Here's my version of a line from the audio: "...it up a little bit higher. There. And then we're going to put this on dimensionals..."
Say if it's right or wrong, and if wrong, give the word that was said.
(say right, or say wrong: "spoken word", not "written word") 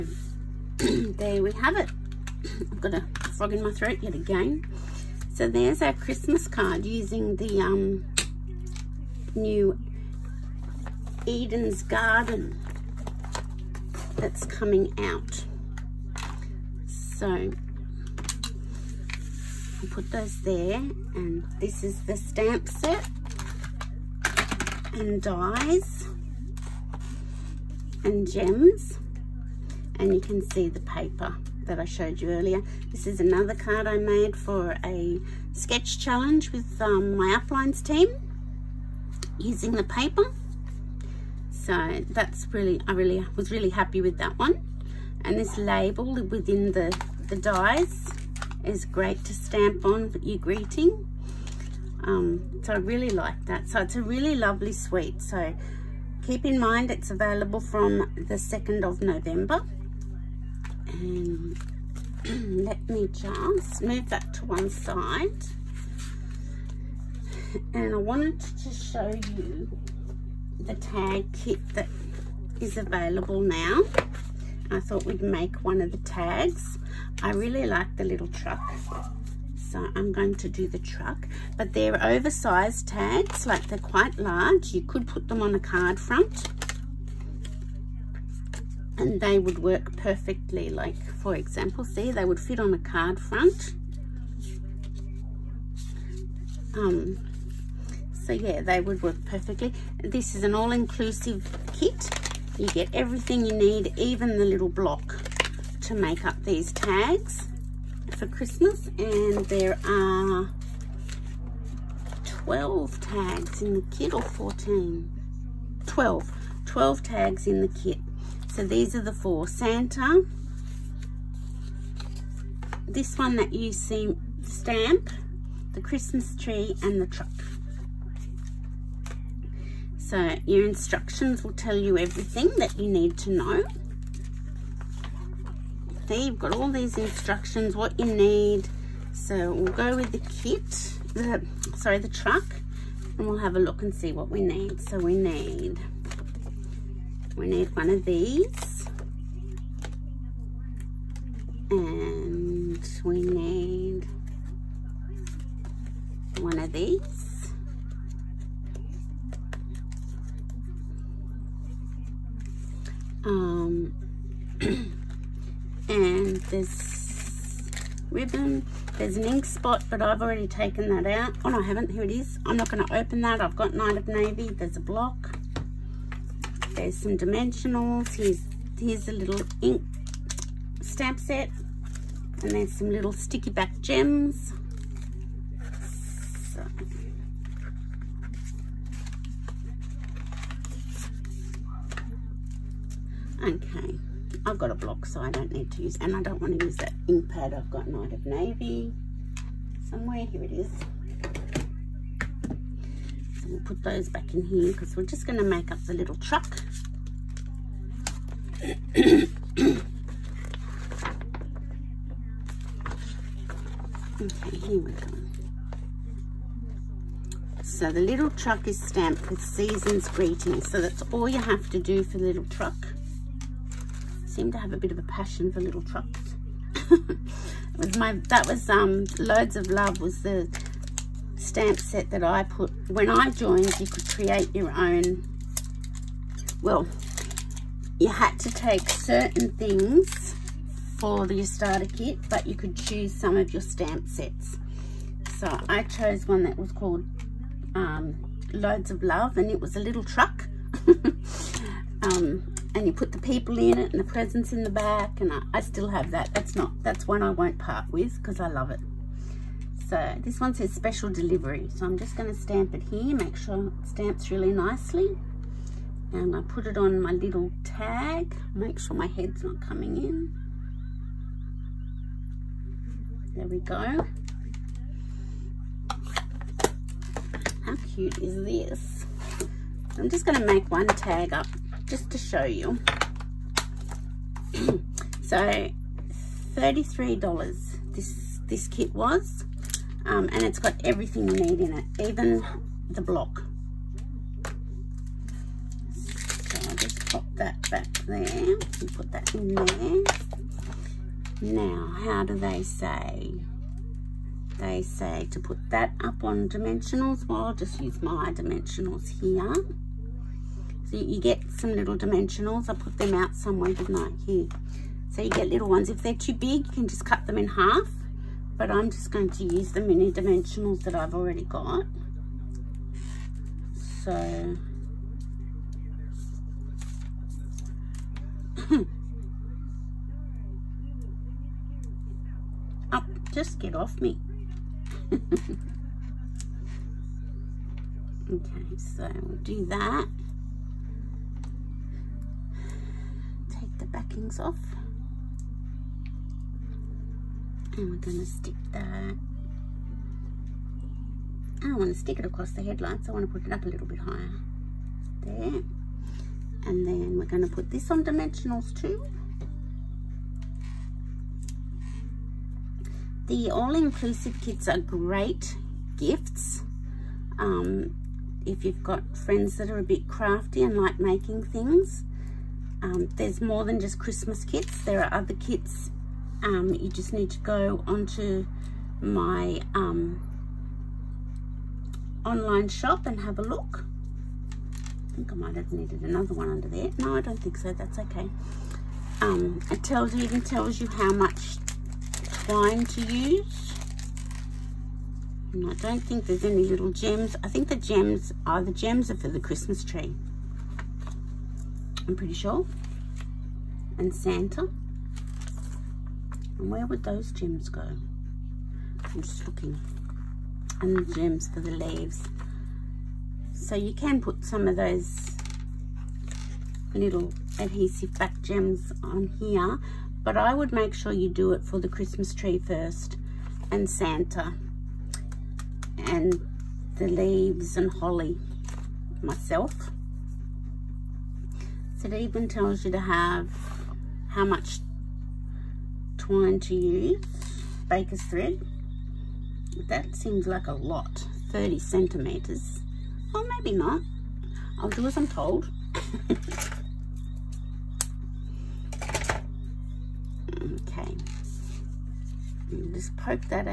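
right.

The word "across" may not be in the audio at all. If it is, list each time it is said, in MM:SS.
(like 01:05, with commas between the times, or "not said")
05:52.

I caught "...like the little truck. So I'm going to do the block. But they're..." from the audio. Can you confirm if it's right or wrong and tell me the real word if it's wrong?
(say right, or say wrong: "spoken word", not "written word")
wrong: "truck", not "block".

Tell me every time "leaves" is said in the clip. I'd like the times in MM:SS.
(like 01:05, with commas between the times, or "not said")
06:51, 07:07.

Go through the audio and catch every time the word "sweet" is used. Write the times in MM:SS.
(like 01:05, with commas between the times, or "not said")
00:54.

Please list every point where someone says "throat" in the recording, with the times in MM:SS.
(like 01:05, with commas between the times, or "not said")
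00:03.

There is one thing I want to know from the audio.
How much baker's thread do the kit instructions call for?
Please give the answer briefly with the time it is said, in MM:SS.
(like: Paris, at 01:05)
30 centimetres, at 07:21.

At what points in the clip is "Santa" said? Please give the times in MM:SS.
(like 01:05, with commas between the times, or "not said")
01:59, 06:44, 07:03.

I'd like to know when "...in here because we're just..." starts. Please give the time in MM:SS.
03:24.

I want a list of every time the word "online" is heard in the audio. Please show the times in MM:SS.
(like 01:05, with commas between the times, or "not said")
06:22.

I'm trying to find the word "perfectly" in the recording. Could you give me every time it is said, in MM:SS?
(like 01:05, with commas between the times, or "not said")
01:29, 01:39.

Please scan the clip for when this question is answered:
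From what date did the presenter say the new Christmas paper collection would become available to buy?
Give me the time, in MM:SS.
00:58.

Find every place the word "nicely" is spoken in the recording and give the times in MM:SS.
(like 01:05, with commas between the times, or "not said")
04:24.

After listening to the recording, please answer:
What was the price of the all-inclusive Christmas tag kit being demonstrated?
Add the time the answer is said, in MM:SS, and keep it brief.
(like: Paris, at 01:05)
$33, at 04:46.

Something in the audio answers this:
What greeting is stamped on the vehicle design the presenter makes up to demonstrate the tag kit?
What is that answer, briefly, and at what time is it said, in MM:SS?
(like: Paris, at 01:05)
Special delivery, at 04:20.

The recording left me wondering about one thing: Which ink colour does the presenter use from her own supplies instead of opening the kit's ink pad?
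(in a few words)
Night of Navy.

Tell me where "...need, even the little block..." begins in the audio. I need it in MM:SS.
01:43.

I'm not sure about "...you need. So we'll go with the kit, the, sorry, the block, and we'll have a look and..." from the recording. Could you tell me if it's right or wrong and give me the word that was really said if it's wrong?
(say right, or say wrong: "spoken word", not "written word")
wrong: "truck", not "block".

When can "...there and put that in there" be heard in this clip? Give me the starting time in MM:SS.
04:58.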